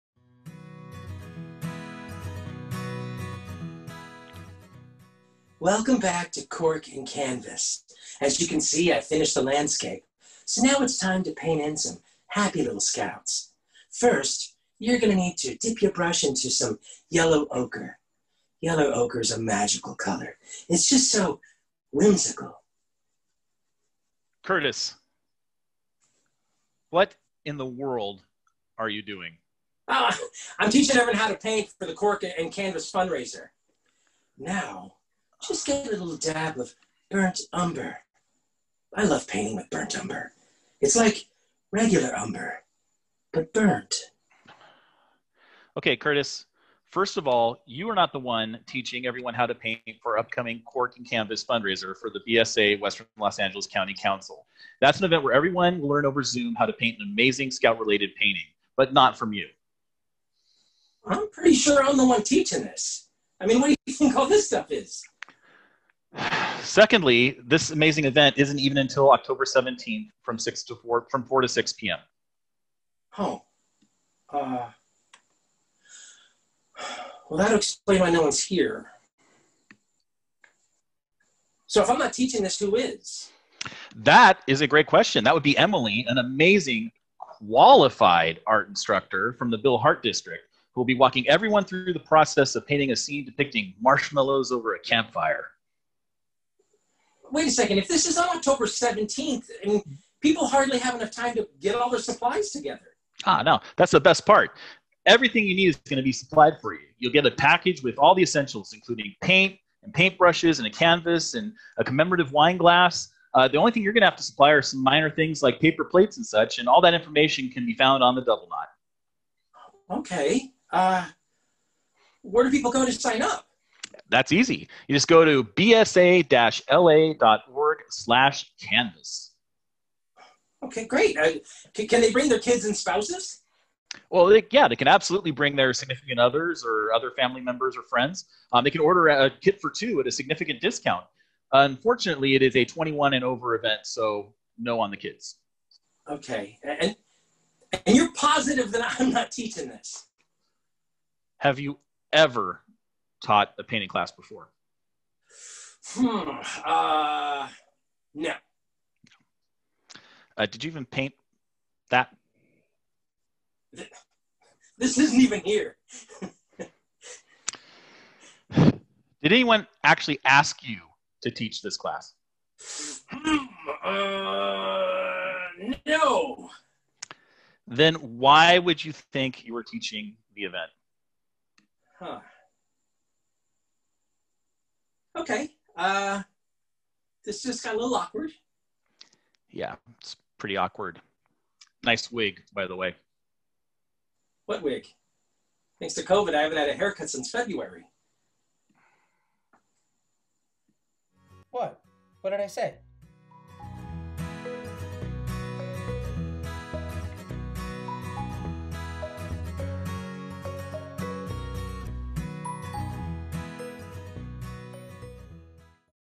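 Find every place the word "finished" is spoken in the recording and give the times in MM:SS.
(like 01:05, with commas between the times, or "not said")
00:08.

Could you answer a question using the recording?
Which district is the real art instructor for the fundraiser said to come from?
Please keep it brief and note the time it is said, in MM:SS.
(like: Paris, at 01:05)
Bill Hart District, at 01:29.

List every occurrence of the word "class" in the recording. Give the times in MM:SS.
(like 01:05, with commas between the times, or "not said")
02:33, 02:51.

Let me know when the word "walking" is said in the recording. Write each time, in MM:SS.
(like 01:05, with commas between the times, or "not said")
01:30.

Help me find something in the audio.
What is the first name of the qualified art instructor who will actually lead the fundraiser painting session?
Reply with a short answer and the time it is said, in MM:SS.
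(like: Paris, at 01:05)
Emily, at 01:25.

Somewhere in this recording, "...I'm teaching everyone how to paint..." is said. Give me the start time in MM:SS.
00:30.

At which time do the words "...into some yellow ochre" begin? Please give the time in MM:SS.
00:16.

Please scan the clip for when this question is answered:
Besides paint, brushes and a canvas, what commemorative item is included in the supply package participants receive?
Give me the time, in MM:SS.
01:51.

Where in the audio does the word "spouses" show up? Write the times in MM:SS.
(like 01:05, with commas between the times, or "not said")
02:12.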